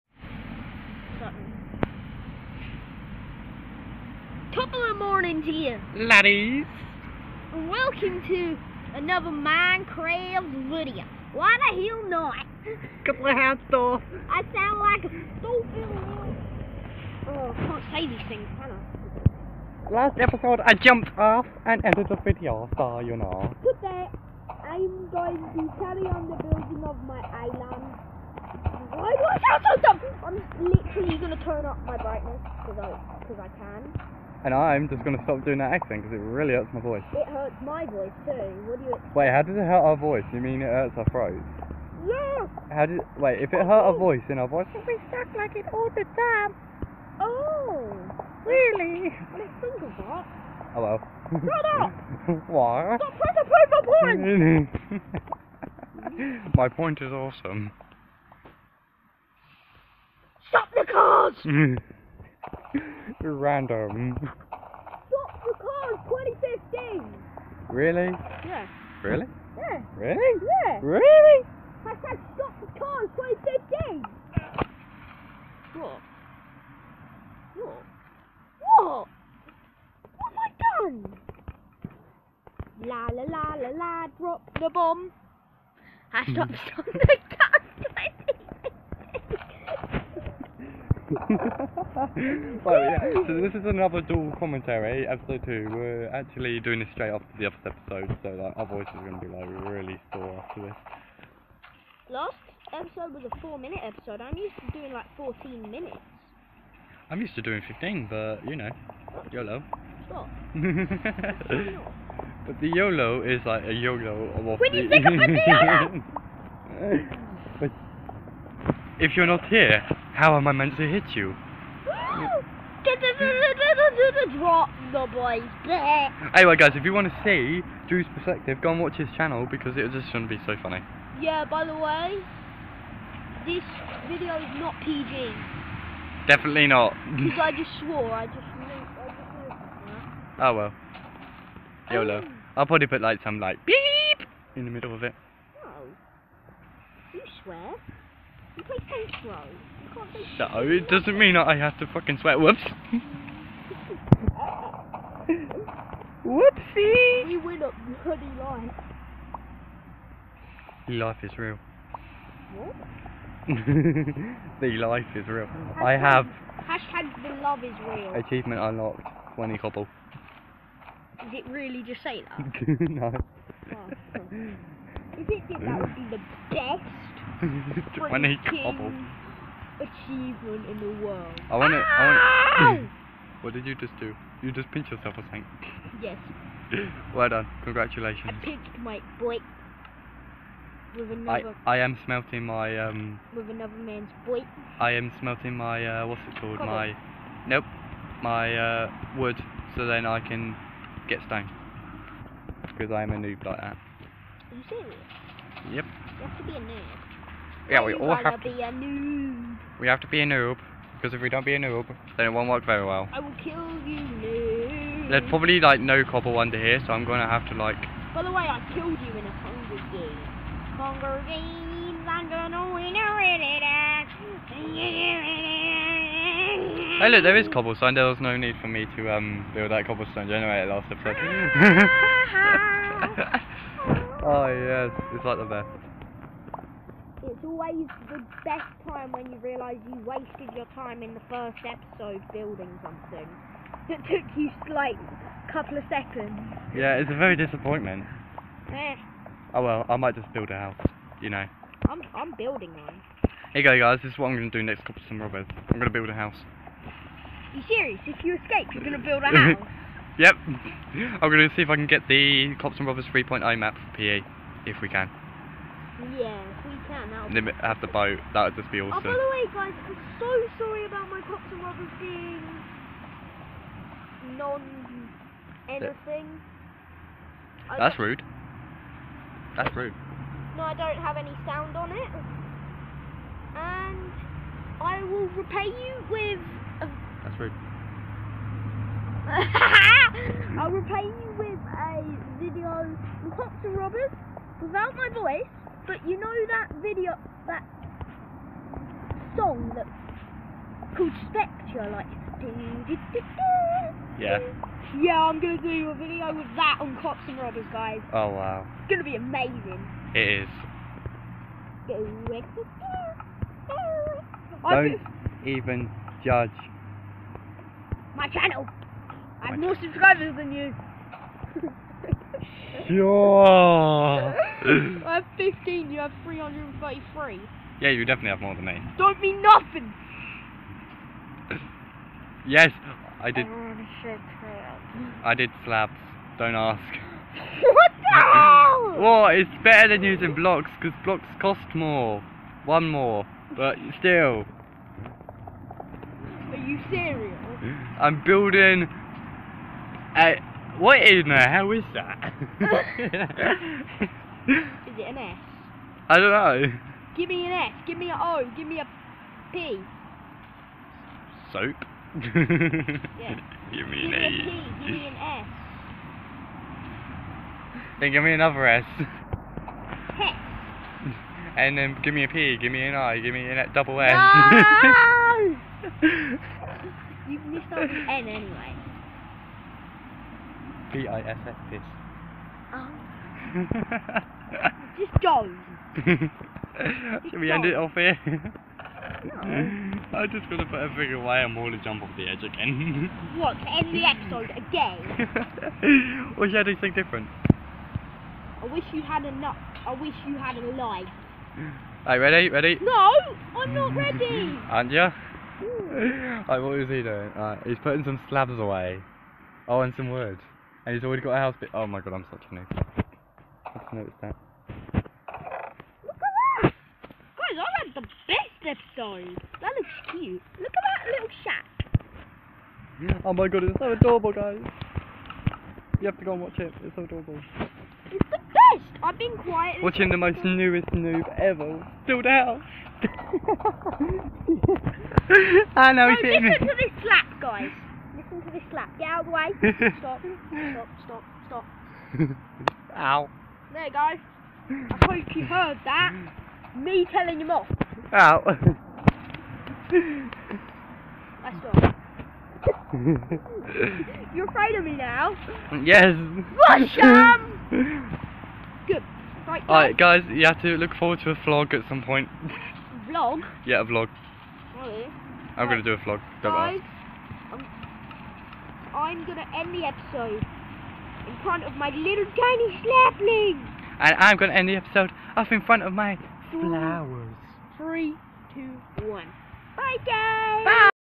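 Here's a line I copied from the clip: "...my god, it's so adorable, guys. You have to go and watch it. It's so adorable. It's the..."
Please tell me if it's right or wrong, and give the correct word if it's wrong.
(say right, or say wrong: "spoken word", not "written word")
right.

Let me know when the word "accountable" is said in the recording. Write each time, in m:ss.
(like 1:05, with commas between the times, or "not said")
not said.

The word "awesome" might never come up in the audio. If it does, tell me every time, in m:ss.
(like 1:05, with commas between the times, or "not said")
0:57, 4:28.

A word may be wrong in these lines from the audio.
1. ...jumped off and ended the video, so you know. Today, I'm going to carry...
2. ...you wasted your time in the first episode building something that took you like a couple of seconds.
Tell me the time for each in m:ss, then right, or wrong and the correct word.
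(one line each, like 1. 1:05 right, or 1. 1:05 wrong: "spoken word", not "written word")
1. 0:20 right
2. 3:59 right.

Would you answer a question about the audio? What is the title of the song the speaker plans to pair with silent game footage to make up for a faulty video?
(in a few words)
Spectre.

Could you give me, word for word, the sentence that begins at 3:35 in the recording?
There's probably like no copper under here, so I'm gonna have to like.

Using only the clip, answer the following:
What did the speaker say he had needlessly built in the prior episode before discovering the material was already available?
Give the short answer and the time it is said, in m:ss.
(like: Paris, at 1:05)
cobblestone generator, at 3:49.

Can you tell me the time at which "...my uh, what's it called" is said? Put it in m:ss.
3:15.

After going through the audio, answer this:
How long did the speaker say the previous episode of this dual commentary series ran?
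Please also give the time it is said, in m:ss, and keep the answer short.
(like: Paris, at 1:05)
4 minutes, at 1:43.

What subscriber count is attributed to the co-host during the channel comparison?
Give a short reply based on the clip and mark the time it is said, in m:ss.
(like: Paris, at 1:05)
333, at 5:26.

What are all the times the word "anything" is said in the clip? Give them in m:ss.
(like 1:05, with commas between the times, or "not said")
4:35, 6:36.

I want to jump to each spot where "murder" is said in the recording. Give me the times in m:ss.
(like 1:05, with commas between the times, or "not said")
not said.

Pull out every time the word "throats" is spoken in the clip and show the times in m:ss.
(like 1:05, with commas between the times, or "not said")
0:41.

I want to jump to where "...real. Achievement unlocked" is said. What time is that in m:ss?
2:47.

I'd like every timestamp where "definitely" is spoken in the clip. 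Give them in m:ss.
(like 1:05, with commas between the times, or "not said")
2:16, 5:28.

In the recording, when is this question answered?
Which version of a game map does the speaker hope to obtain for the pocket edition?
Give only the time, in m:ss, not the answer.
4:22.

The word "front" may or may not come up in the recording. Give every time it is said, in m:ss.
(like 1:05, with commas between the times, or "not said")
7:51, 7:55.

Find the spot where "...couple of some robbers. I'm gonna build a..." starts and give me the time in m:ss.
4:14.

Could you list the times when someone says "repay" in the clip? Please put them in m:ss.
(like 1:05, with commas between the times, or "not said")
4:45, 4:50.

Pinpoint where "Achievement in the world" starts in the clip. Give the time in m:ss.
2:59.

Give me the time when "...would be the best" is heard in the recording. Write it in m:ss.
2:55.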